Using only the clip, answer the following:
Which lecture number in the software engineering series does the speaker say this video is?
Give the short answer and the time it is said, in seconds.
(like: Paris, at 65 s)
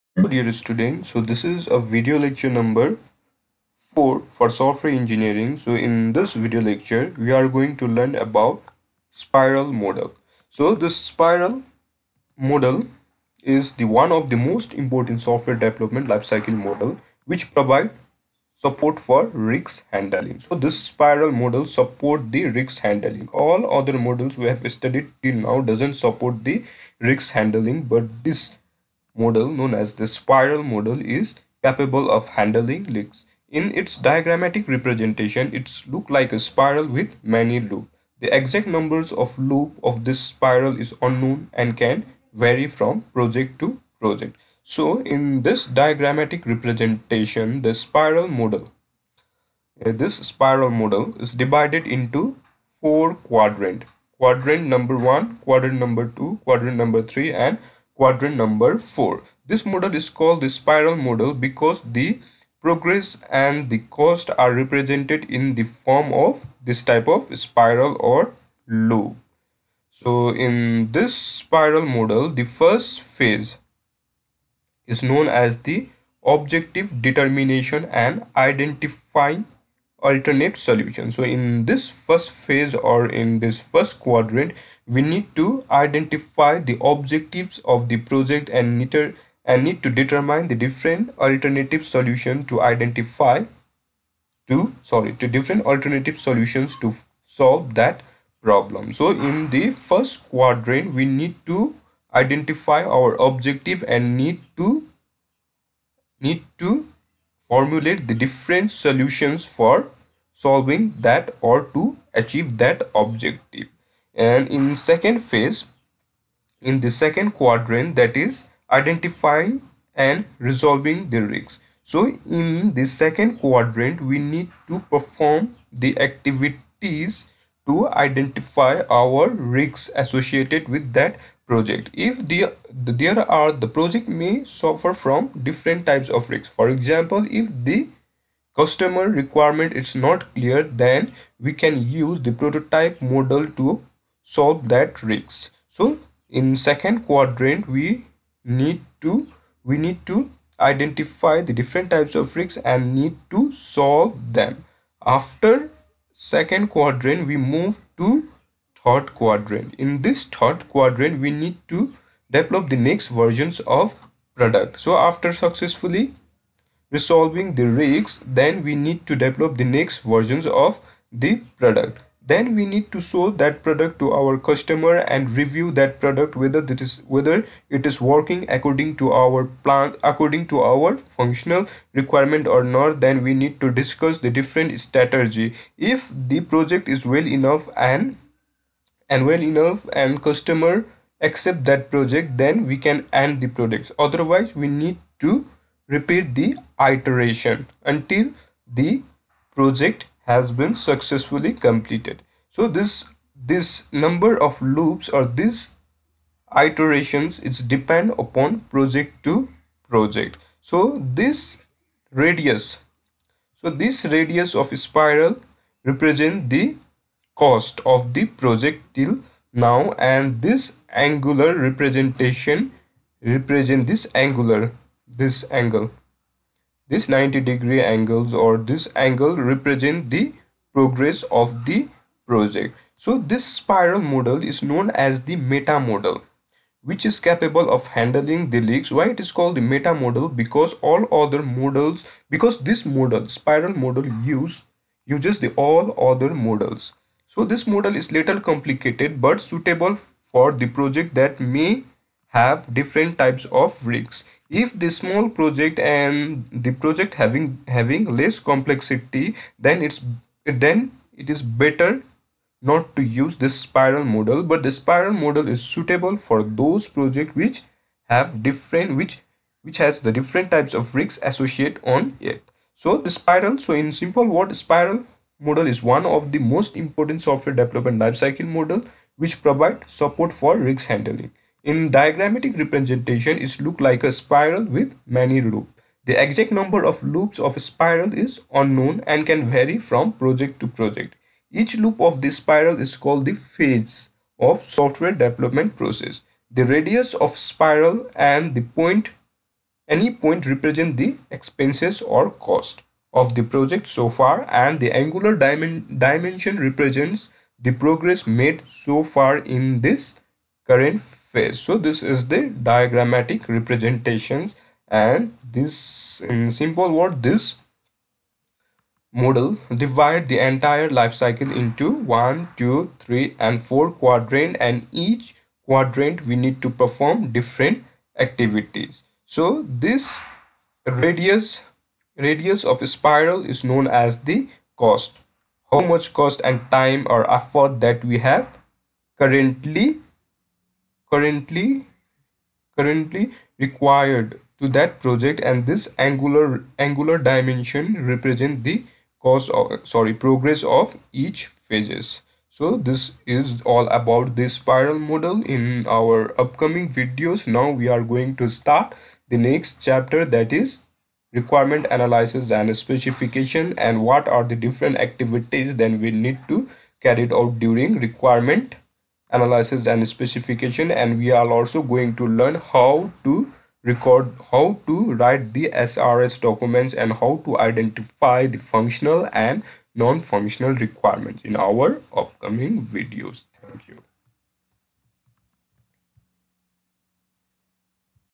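4, at 1 s.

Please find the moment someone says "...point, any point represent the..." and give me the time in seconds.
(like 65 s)
298 s.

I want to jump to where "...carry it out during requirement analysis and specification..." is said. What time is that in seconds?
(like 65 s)
366 s.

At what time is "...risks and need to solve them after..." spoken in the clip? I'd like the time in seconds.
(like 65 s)
152 s.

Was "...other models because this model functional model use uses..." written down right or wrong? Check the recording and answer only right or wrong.
wrong.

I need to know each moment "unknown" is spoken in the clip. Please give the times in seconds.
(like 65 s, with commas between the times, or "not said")
41 s, 288 s.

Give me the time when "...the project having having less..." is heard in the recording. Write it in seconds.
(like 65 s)
256 s.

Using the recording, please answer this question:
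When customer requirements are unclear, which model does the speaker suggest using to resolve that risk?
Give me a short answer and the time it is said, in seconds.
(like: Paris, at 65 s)
Prototype model, at 142 s.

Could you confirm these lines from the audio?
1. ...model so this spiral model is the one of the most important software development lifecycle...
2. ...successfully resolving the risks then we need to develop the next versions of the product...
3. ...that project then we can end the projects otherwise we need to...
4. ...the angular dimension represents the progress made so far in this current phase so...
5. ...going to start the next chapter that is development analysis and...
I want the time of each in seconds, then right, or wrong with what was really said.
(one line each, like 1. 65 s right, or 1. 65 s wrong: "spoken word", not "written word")
1. 9 s right
2. 165 s right
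3. 191 s right
4. 304 s right
5. 358 s wrong: "requirement", not "development".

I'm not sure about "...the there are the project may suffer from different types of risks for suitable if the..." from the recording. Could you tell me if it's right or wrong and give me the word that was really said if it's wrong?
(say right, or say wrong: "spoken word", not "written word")
wrong: "example", not "suitable".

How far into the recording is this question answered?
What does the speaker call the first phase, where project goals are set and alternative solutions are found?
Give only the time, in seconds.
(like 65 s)
76 s.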